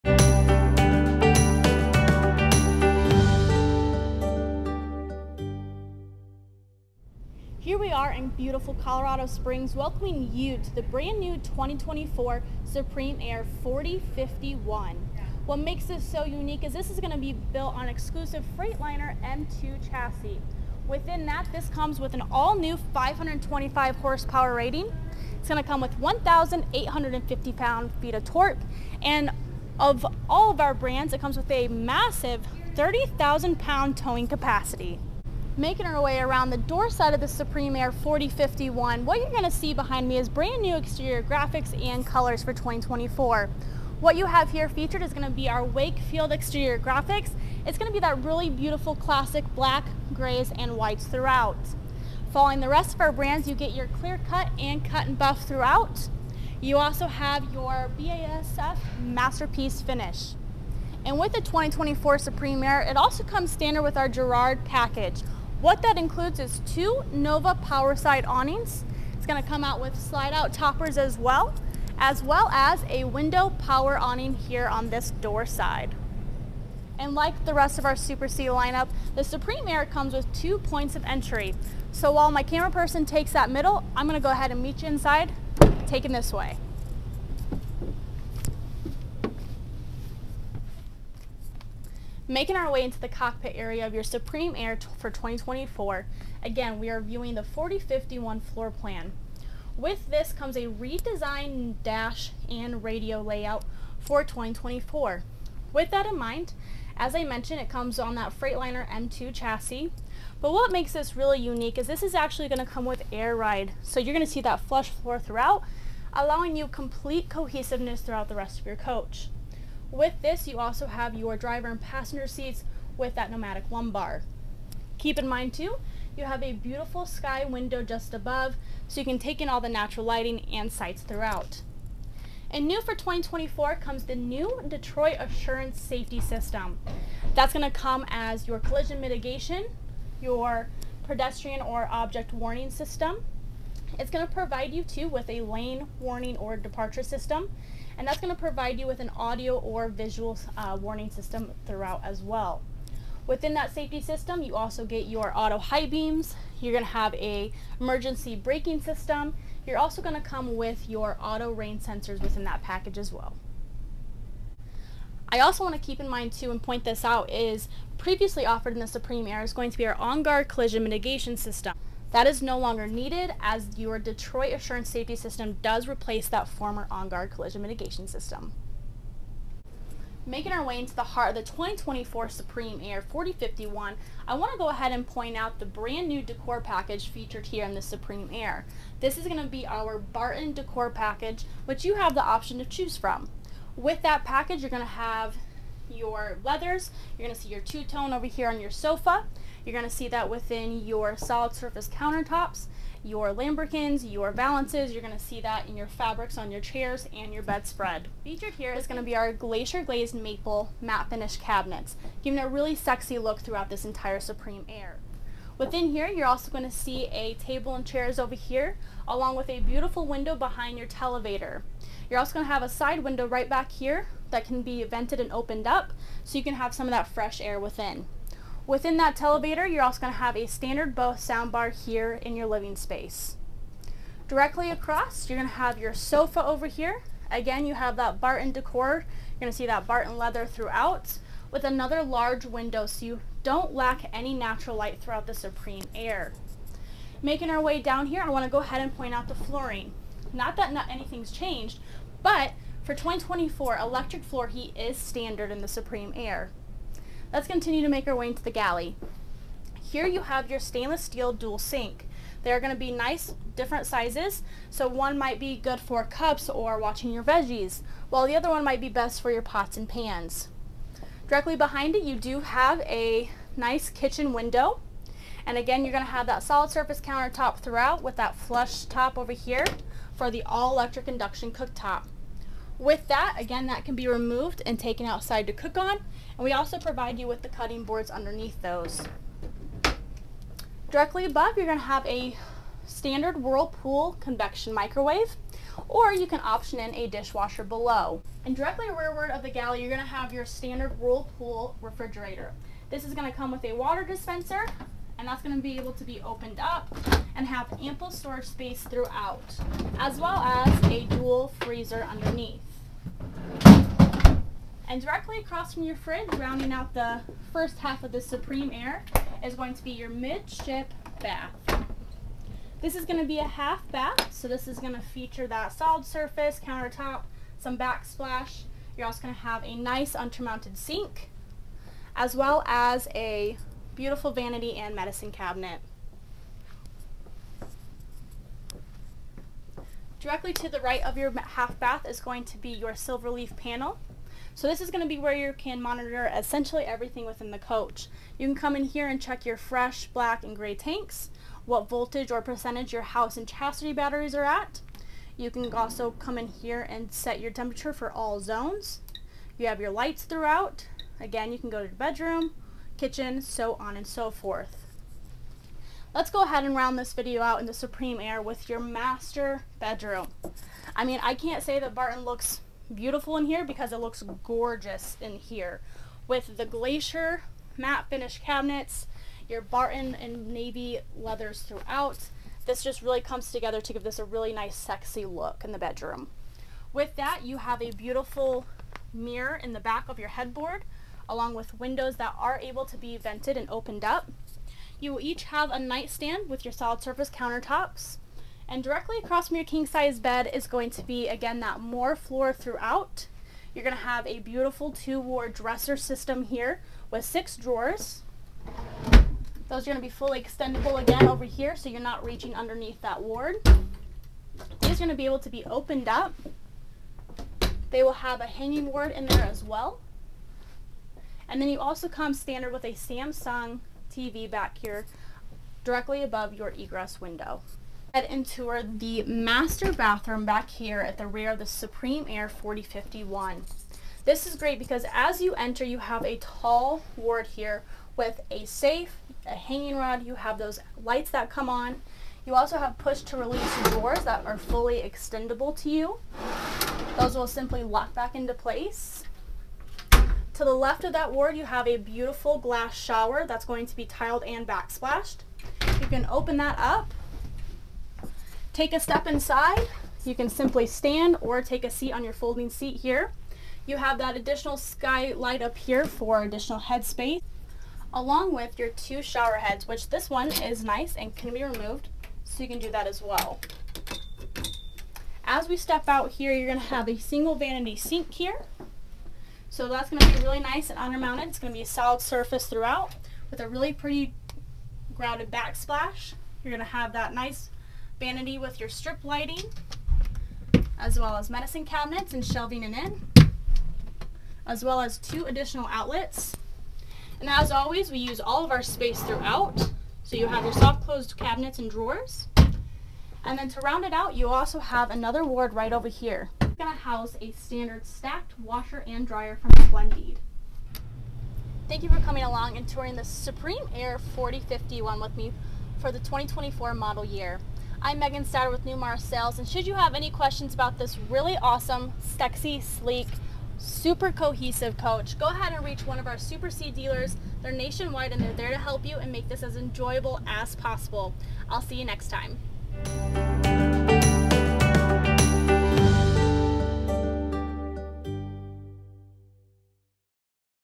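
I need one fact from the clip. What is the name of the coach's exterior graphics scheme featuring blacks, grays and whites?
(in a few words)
Wakefield.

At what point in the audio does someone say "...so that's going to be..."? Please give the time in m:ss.
7:59.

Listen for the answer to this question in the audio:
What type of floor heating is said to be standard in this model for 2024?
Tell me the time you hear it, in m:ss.
4:13.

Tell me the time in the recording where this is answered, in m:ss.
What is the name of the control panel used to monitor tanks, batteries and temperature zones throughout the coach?
5:42.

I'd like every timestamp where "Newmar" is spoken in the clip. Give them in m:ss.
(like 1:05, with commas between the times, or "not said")
8:38.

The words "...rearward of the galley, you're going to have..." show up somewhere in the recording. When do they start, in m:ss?
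4:58.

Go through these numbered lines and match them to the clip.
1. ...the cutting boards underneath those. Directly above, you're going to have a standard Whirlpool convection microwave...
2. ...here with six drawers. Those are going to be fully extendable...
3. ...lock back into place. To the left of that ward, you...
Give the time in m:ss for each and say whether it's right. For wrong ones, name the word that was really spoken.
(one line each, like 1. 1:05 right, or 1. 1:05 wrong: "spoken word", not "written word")
1. 4:47 right
2. 6:46 right
3. 7:27 right.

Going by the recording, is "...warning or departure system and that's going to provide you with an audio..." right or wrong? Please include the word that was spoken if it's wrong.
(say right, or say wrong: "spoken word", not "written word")
right.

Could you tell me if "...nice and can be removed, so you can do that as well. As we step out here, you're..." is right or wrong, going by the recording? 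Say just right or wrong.
right.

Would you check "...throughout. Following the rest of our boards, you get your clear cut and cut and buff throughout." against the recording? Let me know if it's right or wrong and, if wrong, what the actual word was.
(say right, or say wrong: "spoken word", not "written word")
wrong: "brands", not "boards".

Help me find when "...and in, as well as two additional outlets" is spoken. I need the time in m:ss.
8:12.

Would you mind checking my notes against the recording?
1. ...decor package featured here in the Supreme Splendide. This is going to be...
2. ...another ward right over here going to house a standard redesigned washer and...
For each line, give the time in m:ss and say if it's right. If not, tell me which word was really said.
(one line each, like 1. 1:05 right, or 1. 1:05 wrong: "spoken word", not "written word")
1. 3:06 wrong: "Aire", not "Splendide"
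2. 8:25 wrong: "stacked", not "redesigned".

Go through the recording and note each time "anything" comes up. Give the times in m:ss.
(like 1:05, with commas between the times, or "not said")
4:10.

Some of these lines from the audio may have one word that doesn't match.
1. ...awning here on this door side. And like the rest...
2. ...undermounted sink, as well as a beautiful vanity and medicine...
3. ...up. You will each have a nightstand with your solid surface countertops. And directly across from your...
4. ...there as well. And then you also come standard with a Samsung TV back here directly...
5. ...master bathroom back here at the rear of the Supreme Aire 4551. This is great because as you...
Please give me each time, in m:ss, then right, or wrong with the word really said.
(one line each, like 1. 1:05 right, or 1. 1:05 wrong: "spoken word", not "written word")
1. 1:13 right
2. 5:30 right
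3. 6:34 right
4. 6:59 right
5. 7:09 wrong: "4051", not "4551".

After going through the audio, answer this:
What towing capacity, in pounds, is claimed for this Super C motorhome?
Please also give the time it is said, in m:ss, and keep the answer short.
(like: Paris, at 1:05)
30,000 pounds, at 0:32.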